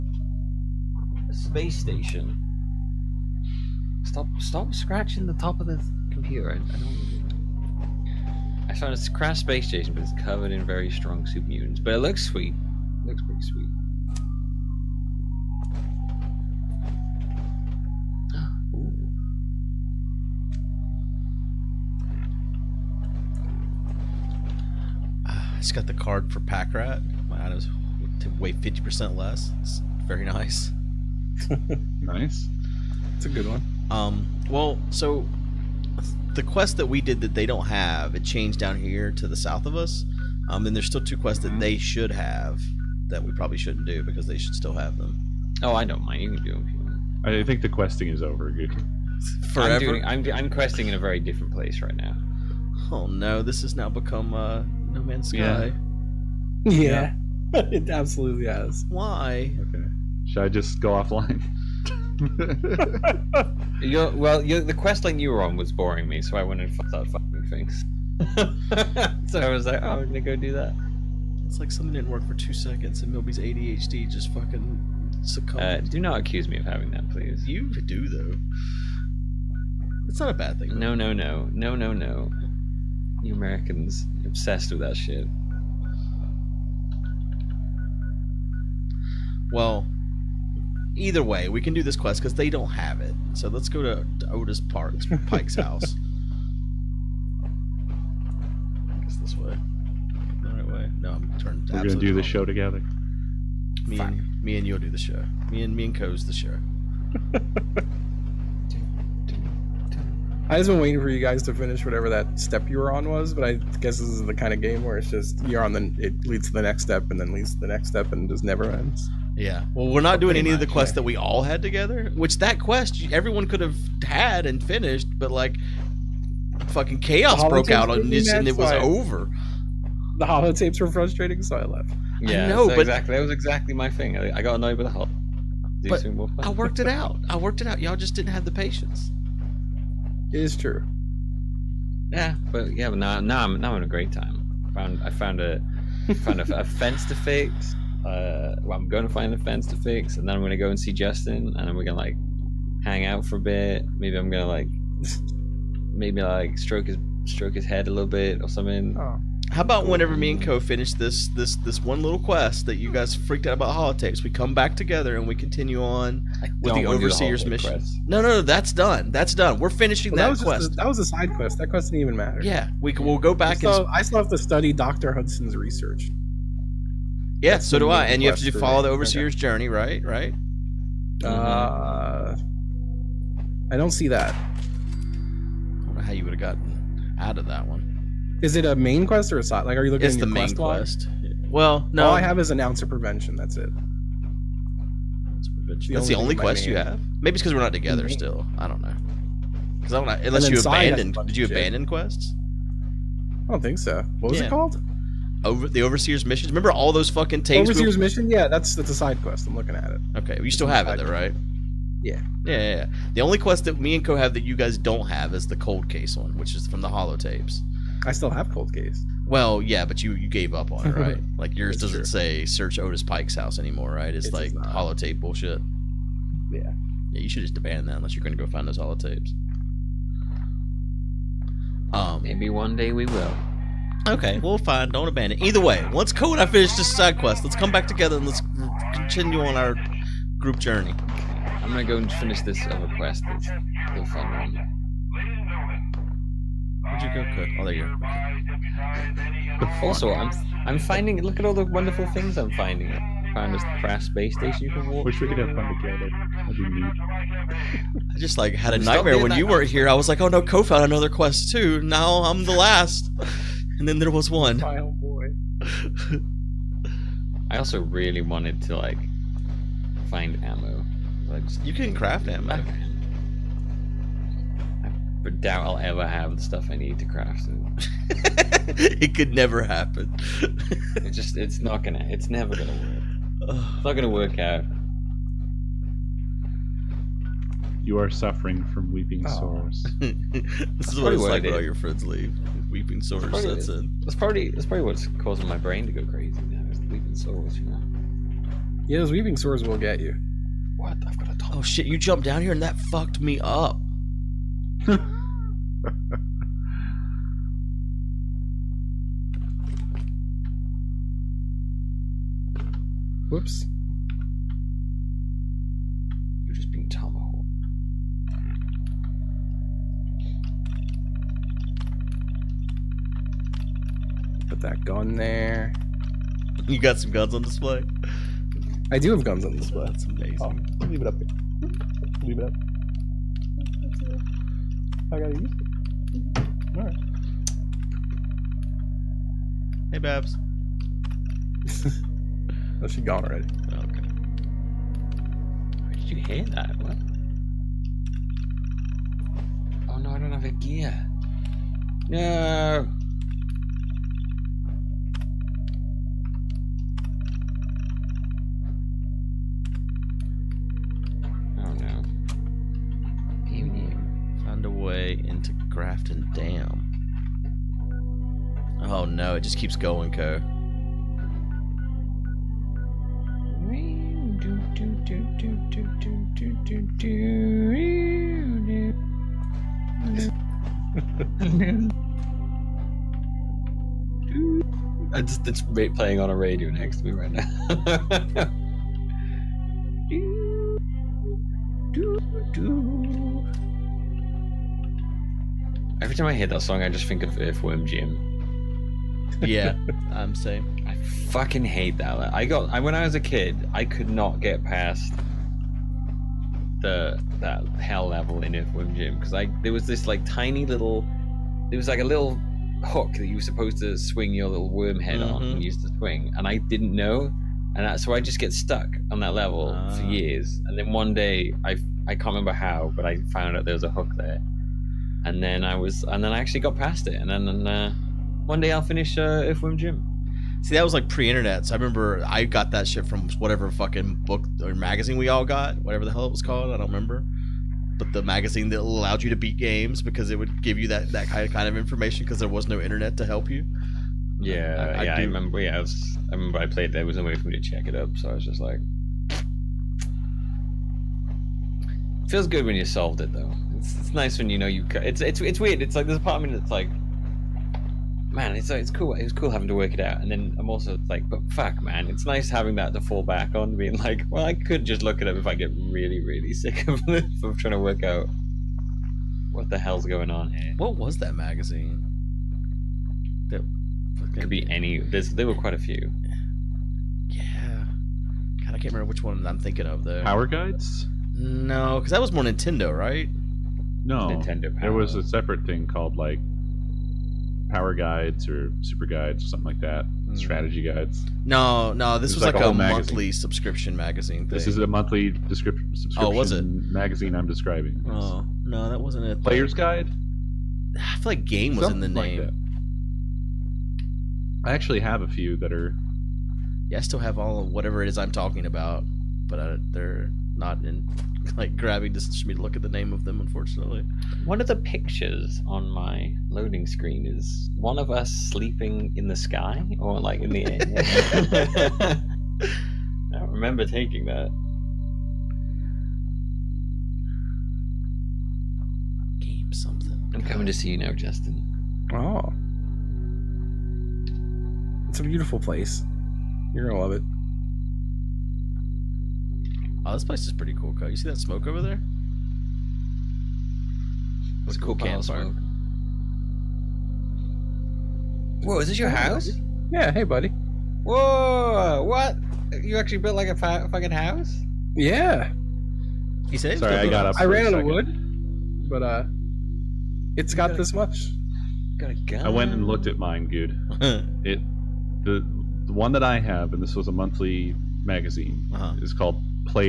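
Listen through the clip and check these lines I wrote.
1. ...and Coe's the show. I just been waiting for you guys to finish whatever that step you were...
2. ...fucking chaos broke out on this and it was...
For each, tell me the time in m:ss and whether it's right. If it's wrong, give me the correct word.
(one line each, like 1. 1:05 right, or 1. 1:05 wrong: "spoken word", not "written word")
1. 1:45 right
2. 2:06 right.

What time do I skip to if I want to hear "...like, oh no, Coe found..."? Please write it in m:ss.
4:20.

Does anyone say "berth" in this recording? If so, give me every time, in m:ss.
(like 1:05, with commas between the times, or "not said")
not said.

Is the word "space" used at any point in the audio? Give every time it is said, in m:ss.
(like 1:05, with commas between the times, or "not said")
0:01, 0:09, 4:14.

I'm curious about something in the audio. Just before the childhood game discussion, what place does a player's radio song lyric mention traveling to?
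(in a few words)
Grafton Dam.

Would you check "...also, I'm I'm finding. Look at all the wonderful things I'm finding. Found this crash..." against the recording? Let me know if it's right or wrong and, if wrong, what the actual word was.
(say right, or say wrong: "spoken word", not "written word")
right.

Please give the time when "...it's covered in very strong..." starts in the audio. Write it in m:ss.
0:10.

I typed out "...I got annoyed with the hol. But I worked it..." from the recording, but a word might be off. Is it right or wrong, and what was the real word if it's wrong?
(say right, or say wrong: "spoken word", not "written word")
right.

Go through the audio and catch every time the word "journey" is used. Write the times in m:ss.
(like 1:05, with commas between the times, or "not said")
2:59, 4:00.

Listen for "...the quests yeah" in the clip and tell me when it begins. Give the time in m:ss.
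2:00.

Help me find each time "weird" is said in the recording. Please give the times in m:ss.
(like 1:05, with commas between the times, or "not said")
7:35.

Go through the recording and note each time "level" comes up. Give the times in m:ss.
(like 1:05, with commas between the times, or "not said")
6:48, 6:59.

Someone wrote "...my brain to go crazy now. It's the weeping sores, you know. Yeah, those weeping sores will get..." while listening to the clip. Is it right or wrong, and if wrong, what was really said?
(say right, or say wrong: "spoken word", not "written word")
right.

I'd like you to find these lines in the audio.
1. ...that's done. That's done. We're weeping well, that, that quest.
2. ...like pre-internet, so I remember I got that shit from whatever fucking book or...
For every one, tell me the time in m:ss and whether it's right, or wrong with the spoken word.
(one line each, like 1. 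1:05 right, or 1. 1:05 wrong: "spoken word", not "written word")
1. 2:48 wrong: "finishing", not "weeping"
2. 7:10 right.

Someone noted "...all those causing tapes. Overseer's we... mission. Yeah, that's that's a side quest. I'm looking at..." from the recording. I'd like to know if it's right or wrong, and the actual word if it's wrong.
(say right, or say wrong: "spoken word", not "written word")
wrong: "fucking", not "causing".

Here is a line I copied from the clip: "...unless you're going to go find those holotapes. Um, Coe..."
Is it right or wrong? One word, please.
wrong.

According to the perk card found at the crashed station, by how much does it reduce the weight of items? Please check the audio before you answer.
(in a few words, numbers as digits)
50 percent.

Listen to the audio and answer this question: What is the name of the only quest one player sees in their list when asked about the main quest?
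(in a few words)
An Ounce of Prevention.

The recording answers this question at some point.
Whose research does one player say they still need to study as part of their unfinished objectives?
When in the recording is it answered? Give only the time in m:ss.
2:54.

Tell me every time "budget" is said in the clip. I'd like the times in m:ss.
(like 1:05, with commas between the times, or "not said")
not said.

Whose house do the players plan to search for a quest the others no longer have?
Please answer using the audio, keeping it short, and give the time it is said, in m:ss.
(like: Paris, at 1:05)
Otis Pike, at 1:34.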